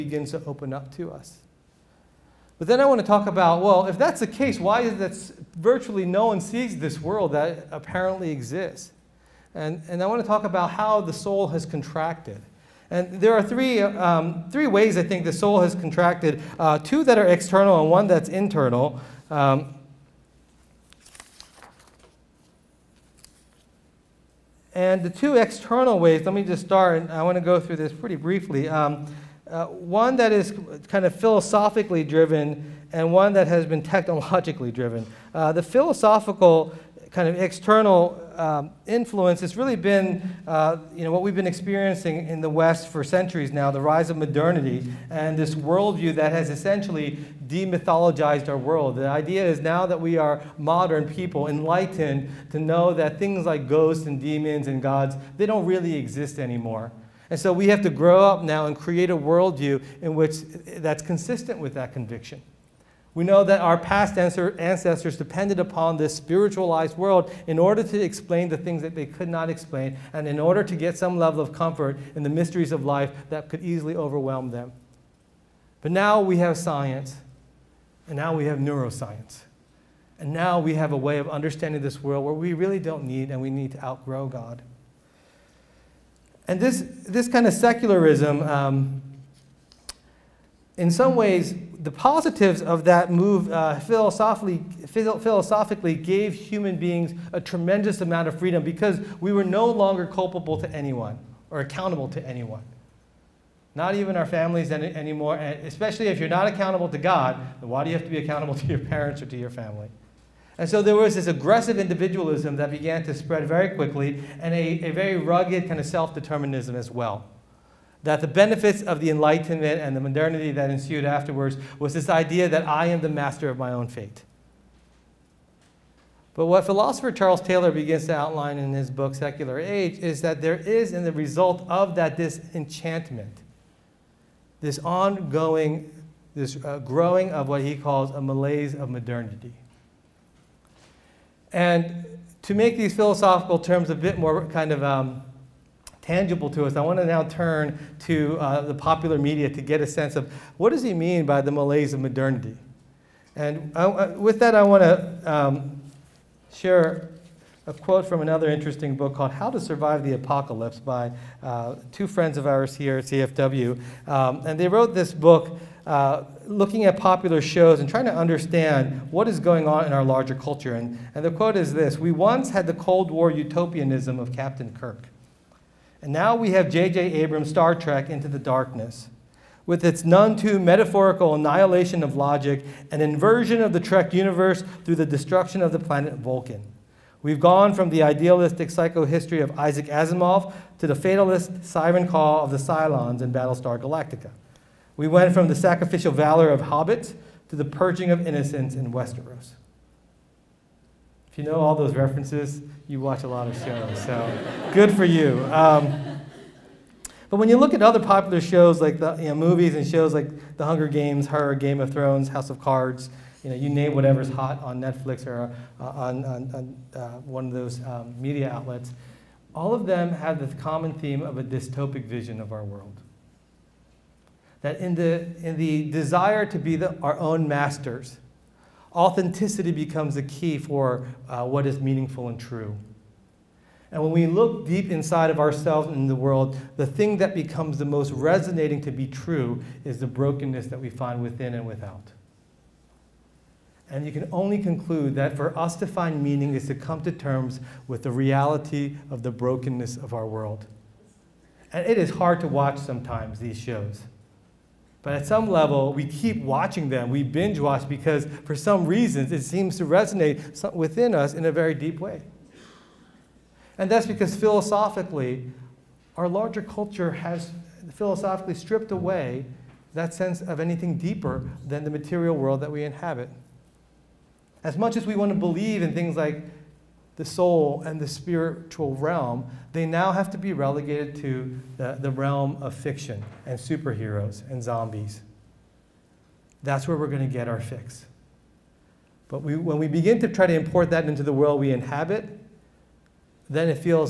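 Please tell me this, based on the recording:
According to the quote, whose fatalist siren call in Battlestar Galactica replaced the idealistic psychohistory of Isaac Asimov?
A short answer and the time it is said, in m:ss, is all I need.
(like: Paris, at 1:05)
The Cylons, at 3:12.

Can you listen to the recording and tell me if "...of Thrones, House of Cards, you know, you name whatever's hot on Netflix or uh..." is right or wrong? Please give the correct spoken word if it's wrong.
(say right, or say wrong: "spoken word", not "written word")
right.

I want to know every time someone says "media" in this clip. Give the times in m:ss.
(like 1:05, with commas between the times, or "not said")
2:29, 3:38.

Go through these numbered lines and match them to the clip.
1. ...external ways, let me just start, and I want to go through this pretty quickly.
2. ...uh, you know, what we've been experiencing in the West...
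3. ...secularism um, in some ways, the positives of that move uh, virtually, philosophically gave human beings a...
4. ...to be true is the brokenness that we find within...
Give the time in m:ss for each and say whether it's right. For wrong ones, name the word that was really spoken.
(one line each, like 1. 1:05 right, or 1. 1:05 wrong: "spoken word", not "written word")
1. 0:25 wrong: "briefly", not "quickly"
2. 0:40 right
3. 1:27 wrong: "philosophically", not "virtually"
4. 3:58 right.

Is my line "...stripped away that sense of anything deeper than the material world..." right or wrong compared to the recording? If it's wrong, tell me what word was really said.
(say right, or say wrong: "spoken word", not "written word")
right.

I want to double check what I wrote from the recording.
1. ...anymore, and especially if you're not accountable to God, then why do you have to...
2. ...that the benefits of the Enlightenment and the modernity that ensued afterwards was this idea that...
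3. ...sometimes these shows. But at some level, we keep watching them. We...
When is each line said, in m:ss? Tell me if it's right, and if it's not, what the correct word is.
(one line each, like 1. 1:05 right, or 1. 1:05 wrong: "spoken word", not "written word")
1. 1:44 right
2. 1:58 right
3. 4:12 right.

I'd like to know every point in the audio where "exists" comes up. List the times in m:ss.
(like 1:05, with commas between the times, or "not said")
0:08, 0:55.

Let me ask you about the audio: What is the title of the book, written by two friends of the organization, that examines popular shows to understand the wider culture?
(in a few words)
How to Survive the Apocalypse.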